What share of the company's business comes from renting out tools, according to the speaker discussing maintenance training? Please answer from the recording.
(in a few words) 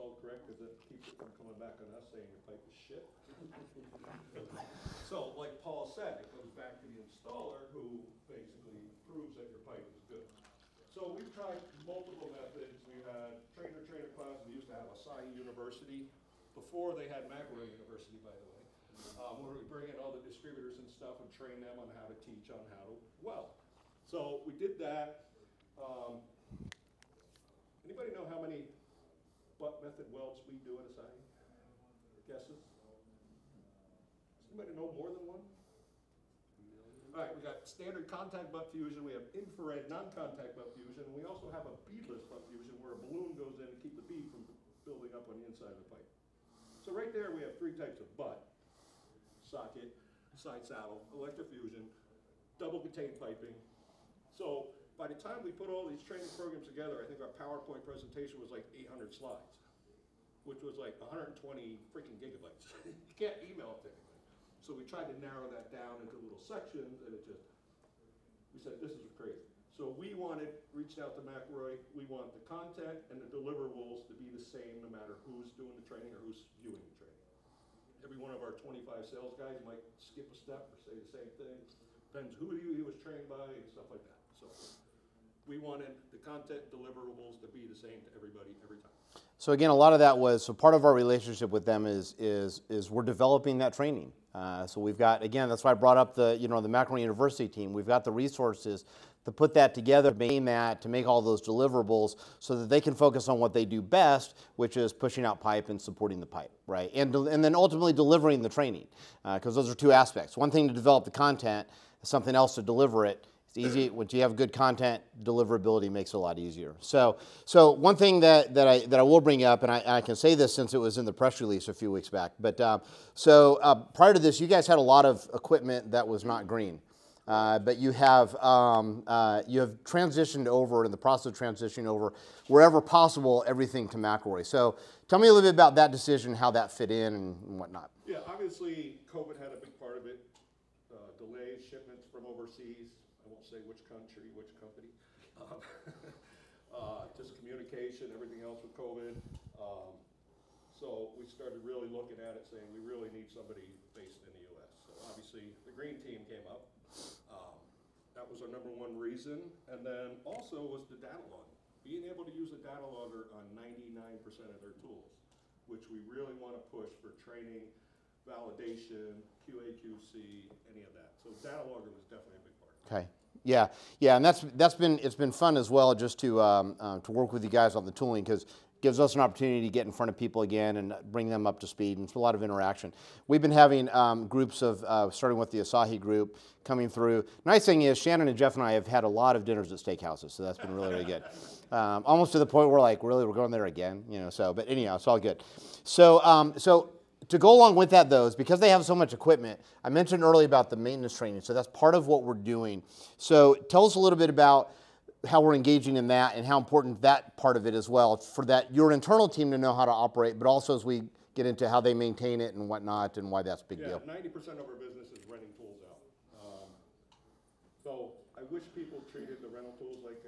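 90%.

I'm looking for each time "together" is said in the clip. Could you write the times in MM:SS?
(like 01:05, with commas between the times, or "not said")
00:56, 01:39.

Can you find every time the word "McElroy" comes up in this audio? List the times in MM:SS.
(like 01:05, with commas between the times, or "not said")
00:17, 01:11, 01:36, 02:13.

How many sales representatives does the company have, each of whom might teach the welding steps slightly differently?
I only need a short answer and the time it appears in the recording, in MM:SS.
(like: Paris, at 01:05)
25, at 01:18.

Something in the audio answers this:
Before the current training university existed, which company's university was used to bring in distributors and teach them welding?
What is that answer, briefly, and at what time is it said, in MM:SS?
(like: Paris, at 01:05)
Asahi University, at 00:14.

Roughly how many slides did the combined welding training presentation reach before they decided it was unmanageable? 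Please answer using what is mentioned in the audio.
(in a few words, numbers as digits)
800.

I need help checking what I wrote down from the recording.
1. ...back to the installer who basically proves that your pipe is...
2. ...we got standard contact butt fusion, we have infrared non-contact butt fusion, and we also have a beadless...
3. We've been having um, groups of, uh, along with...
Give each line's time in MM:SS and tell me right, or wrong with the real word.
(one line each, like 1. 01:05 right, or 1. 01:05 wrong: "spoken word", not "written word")
1. 00:06 right
2. 00:37 right
3. 03:03 wrong: "starting", not "along".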